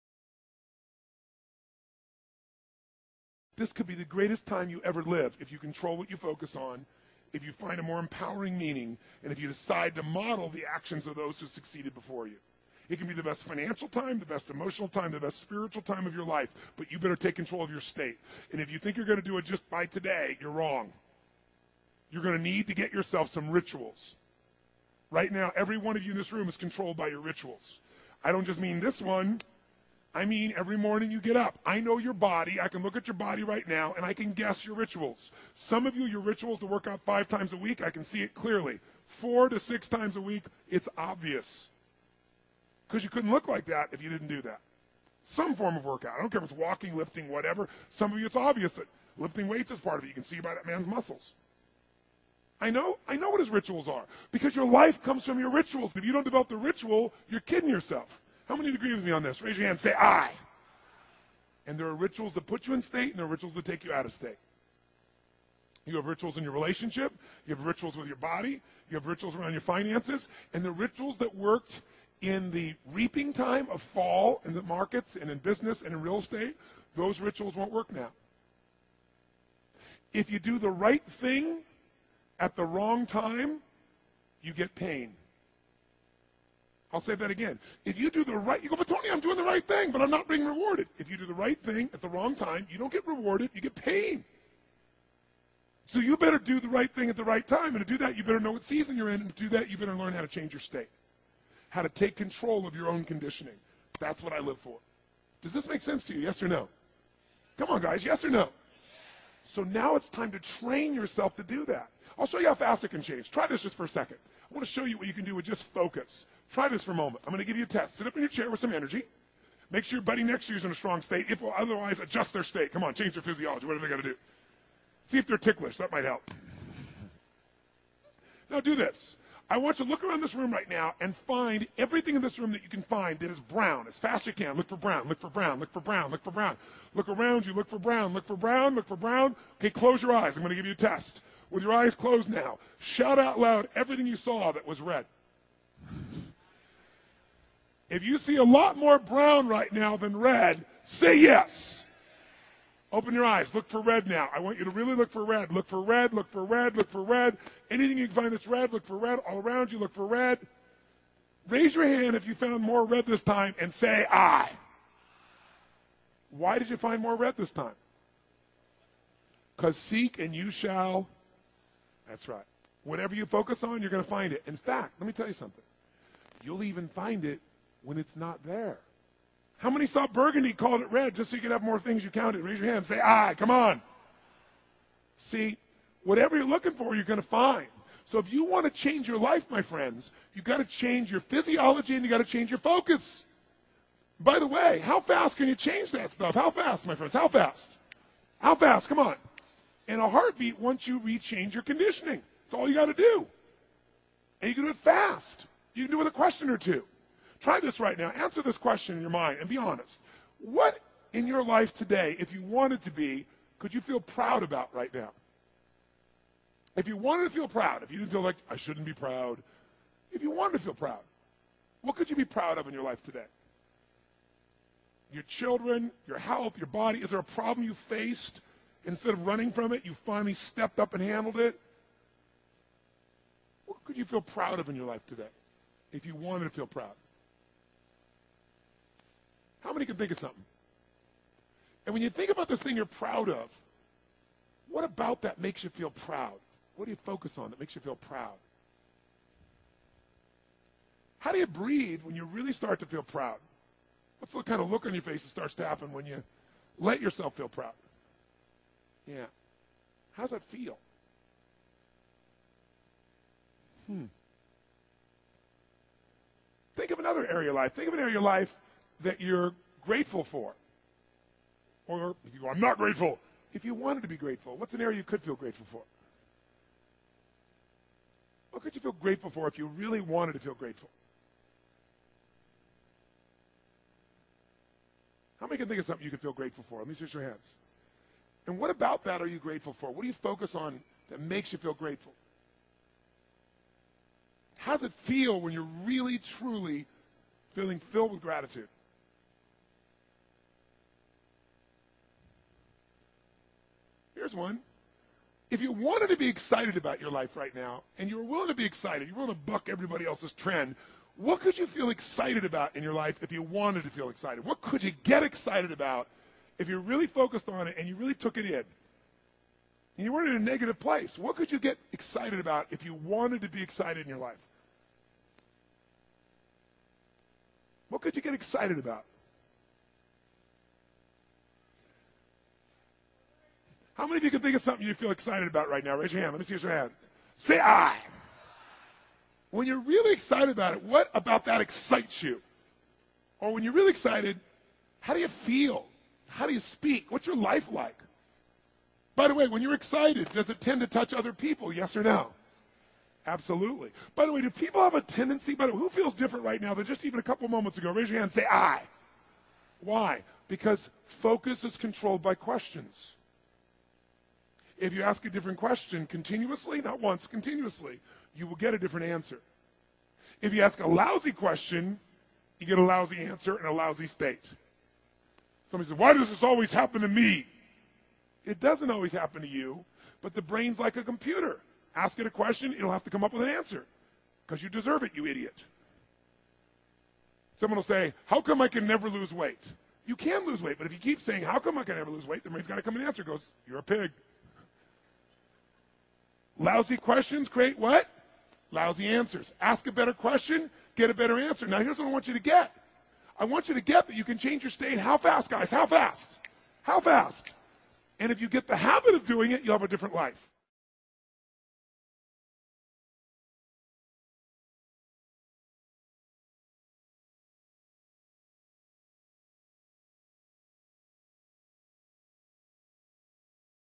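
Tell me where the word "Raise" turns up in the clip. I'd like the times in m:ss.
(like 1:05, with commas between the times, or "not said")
0:59, 2:41, 3:02, 5:35, 5:57.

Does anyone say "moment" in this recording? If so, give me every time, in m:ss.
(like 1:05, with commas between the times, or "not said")
1:56, 5:57.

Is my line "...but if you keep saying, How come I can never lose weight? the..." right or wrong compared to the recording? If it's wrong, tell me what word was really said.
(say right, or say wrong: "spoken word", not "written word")
right.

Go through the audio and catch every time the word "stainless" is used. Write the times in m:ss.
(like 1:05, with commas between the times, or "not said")
not said.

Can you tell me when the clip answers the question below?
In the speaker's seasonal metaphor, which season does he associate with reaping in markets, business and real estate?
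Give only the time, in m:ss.
1:13.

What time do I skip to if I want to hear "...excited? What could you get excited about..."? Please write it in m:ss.
5:14.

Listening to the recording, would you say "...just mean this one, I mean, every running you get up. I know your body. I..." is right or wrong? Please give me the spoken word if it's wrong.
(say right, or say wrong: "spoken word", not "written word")
wrong: "morning", not "running".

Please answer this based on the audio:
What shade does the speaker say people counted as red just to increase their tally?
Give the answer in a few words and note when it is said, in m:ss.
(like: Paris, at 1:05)
burgundy, at 3:00.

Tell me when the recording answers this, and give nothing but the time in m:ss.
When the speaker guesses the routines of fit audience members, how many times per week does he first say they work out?
0:37.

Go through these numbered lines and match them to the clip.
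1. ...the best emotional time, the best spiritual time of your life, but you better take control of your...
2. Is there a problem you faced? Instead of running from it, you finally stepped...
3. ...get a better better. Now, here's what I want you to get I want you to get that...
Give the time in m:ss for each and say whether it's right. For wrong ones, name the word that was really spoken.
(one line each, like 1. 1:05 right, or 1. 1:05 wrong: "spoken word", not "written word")
1. 0:14 right
2. 3:47 right
3. 6:40 wrong: "answer", not "better".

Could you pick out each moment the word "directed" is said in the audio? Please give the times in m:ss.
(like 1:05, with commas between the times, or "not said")
not said.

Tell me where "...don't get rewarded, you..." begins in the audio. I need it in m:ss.
1:32.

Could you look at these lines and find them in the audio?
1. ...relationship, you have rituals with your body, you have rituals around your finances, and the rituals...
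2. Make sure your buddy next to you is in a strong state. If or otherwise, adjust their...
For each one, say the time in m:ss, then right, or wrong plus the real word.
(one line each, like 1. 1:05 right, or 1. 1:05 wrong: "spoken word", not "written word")
1. 1:06 right
2. 1:59 right.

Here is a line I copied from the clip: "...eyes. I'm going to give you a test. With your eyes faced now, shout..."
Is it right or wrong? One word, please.
wrong.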